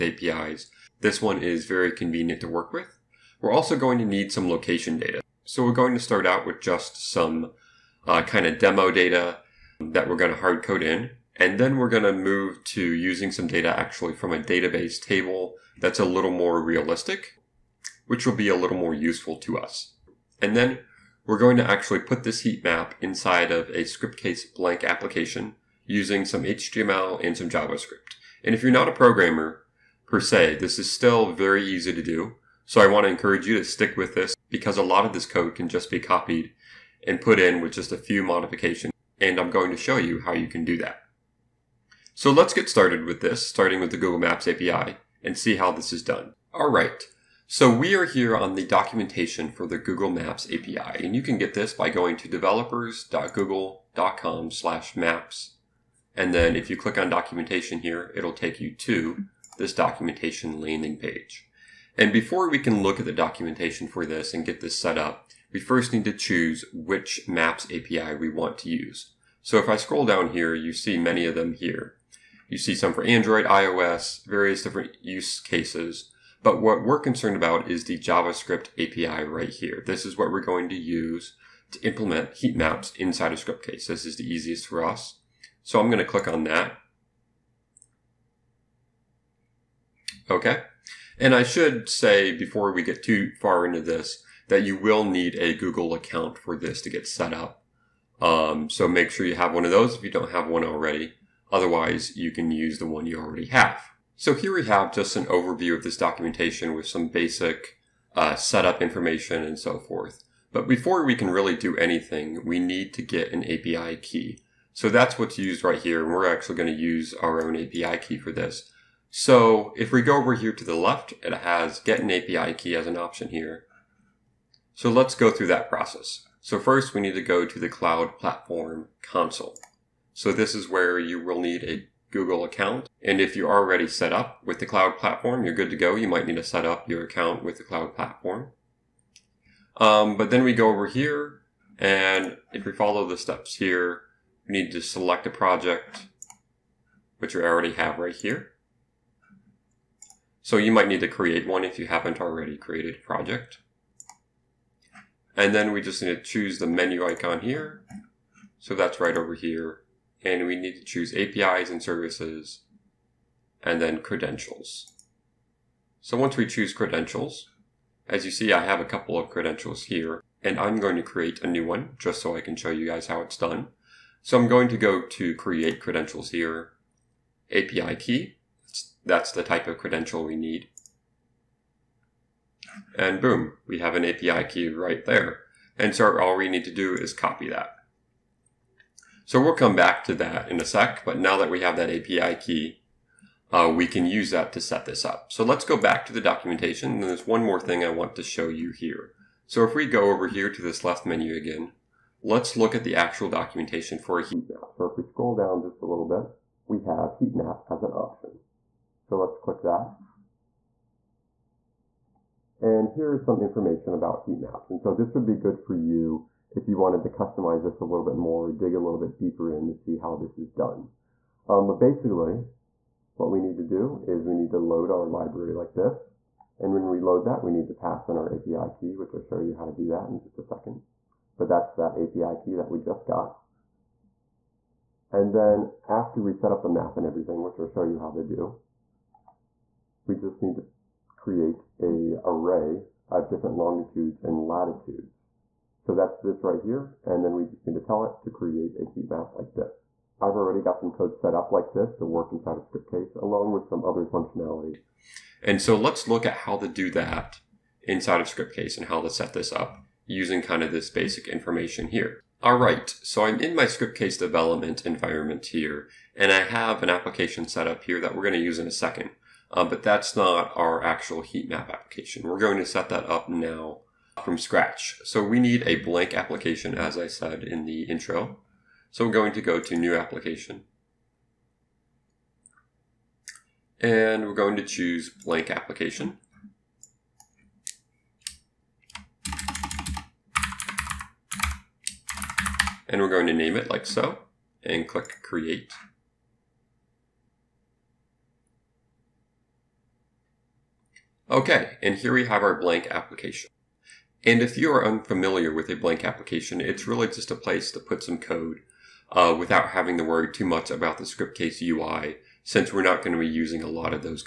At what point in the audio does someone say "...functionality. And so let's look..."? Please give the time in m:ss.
4:14.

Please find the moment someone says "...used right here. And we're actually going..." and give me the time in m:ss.
1:55.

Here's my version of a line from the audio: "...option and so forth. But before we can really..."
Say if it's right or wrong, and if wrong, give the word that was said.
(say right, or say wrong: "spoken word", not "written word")
wrong: "information", not "option".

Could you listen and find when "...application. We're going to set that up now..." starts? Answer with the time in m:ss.
4:31.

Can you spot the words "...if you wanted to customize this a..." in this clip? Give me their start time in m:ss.
3:36.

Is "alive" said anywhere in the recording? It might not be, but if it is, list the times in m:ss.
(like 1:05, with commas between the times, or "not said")
not said.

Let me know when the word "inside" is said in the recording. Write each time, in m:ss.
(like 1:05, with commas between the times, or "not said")
0:22, 1:22, 4:12, 4:17.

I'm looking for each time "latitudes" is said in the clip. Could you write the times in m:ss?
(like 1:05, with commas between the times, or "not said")
4:04.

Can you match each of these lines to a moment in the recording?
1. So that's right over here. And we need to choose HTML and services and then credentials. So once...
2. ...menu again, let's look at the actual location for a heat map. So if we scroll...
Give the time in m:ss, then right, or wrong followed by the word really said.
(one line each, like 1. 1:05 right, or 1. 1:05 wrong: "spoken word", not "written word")
1. 2:38 wrong: "APIs", not "HTML"
2. 3:21 wrong: "documentation", not "location".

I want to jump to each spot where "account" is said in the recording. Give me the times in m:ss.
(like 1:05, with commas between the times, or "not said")
1:35, 2:12, 2:17.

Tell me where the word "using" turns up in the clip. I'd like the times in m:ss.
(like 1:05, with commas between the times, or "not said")
0:12, 0:25, 4:20, 5:13.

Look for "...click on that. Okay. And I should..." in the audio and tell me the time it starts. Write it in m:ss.
1:26.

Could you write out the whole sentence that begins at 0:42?
So let's get started with this, starting with the Google Maps API and see how this is done.